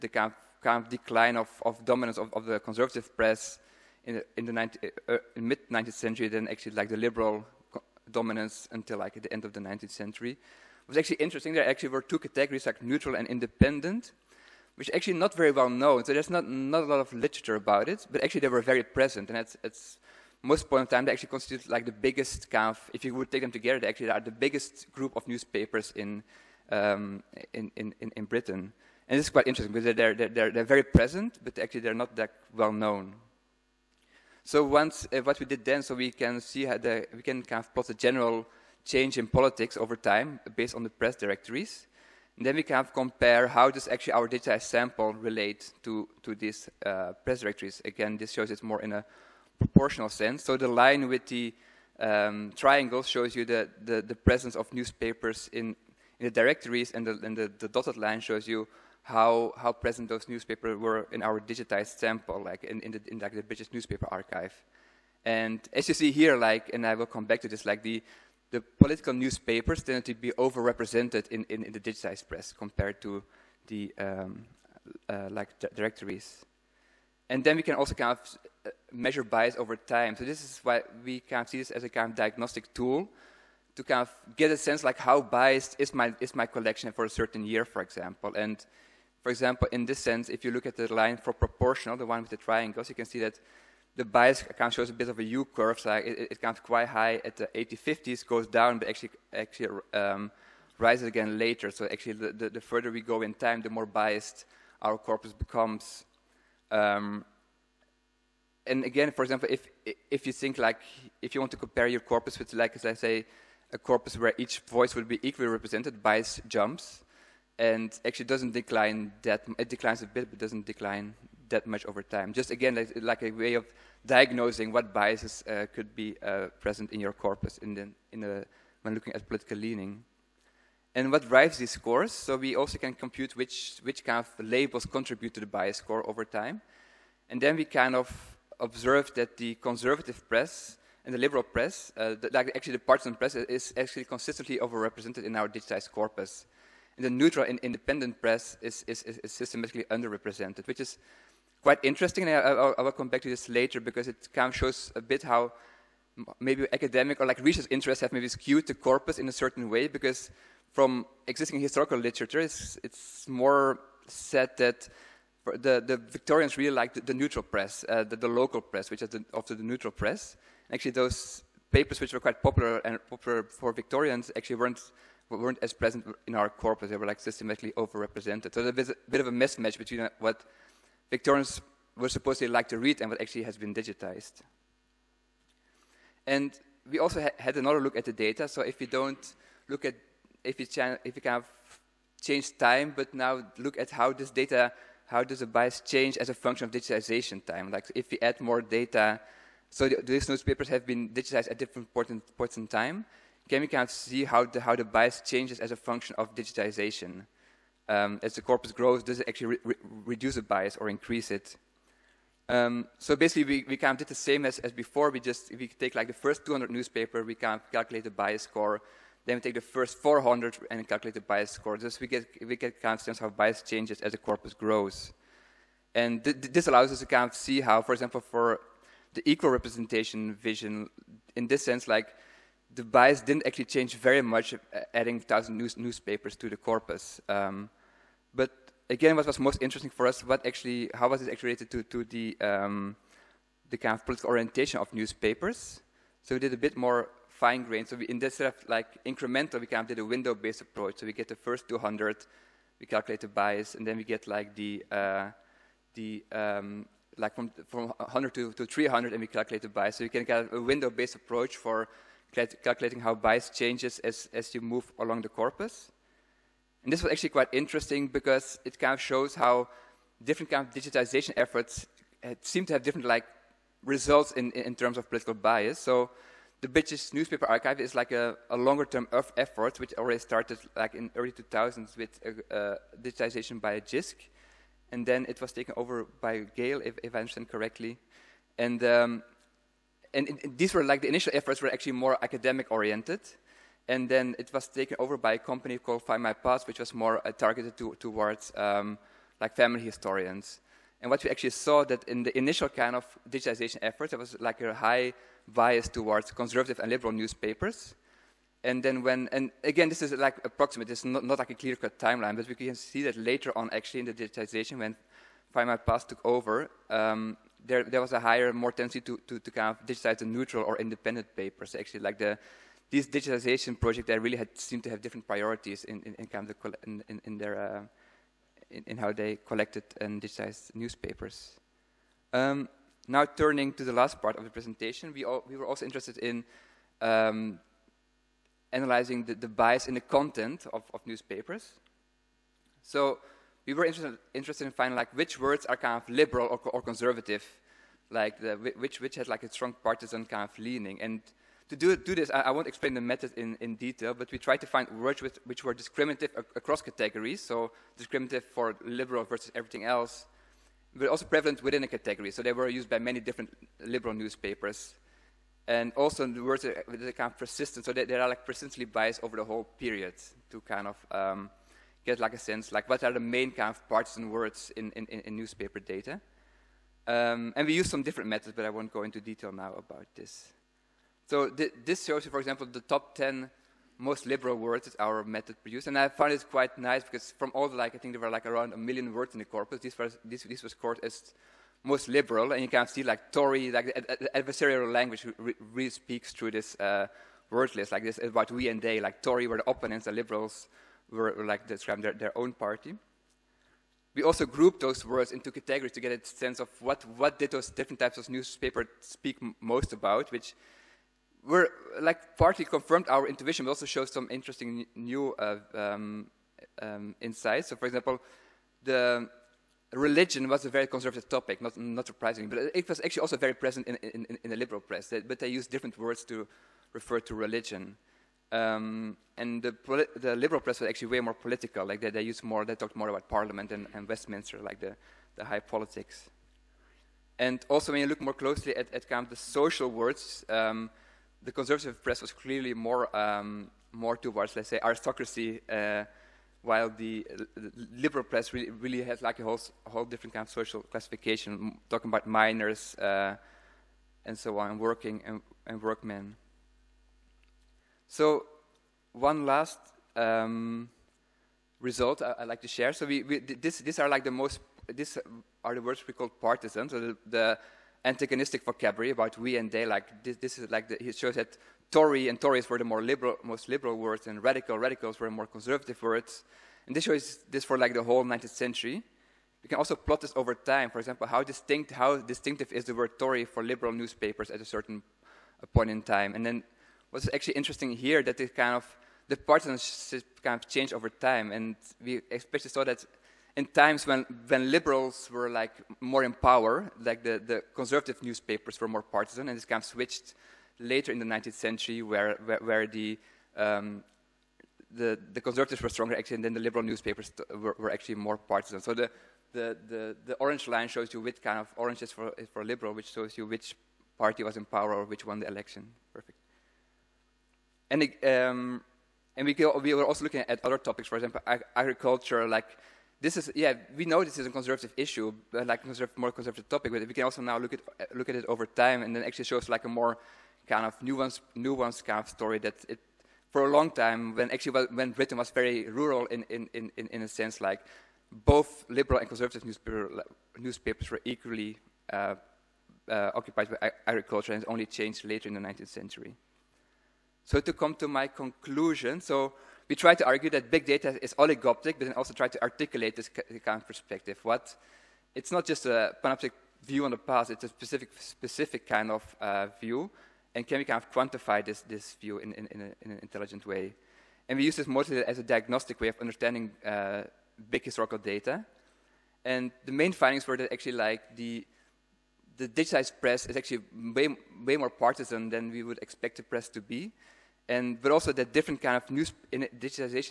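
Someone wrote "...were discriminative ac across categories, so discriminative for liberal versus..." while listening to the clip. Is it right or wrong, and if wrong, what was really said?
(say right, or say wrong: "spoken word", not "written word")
right.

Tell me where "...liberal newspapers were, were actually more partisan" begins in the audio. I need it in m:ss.
8:26.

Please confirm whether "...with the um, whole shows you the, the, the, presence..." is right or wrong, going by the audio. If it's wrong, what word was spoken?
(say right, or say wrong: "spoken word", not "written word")
wrong: "triangle", not "whole".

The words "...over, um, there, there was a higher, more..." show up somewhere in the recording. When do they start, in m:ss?
5:16.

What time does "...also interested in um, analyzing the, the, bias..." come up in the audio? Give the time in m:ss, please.
5:35.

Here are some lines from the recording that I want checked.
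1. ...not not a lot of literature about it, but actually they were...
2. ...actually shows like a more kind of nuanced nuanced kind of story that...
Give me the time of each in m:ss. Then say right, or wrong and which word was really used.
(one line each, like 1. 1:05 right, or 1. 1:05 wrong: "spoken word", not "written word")
1. 0:16 right
2. 8:49 right.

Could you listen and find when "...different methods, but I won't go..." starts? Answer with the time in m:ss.
6:18.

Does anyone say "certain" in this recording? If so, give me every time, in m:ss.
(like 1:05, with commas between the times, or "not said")
1:27, 2:39, 8:04.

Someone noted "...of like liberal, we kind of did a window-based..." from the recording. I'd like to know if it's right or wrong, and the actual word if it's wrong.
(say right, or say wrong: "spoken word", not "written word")
wrong: "incremental", not "liberal".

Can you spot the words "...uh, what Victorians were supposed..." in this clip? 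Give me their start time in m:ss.
2:59.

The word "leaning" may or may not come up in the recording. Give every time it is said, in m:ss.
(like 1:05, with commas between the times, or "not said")
2:09, 5:50.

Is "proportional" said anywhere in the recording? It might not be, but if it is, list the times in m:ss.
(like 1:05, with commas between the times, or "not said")
0:49, 1:31.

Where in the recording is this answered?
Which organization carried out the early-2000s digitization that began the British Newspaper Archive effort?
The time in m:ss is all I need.
4:43.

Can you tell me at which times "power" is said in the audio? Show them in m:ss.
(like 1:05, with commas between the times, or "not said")
8:16, 8:34.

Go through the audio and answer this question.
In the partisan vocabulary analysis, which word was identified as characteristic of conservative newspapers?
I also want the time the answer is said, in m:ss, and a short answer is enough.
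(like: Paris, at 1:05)
Radical, at 7:54.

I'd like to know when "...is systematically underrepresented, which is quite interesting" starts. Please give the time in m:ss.
2:29.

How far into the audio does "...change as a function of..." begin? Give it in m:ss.
3:15.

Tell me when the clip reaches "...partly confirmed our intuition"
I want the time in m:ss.
6:52.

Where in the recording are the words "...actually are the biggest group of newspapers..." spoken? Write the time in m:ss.
0:23.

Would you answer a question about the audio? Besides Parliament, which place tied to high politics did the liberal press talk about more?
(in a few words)
Westminster.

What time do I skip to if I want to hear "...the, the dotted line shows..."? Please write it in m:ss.
0:57.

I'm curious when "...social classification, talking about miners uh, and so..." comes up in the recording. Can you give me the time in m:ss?
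7:30.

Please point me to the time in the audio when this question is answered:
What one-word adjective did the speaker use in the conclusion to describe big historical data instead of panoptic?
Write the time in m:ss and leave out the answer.
9:11.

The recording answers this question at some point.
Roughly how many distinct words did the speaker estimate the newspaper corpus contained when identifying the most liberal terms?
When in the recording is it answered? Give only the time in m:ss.
6:28.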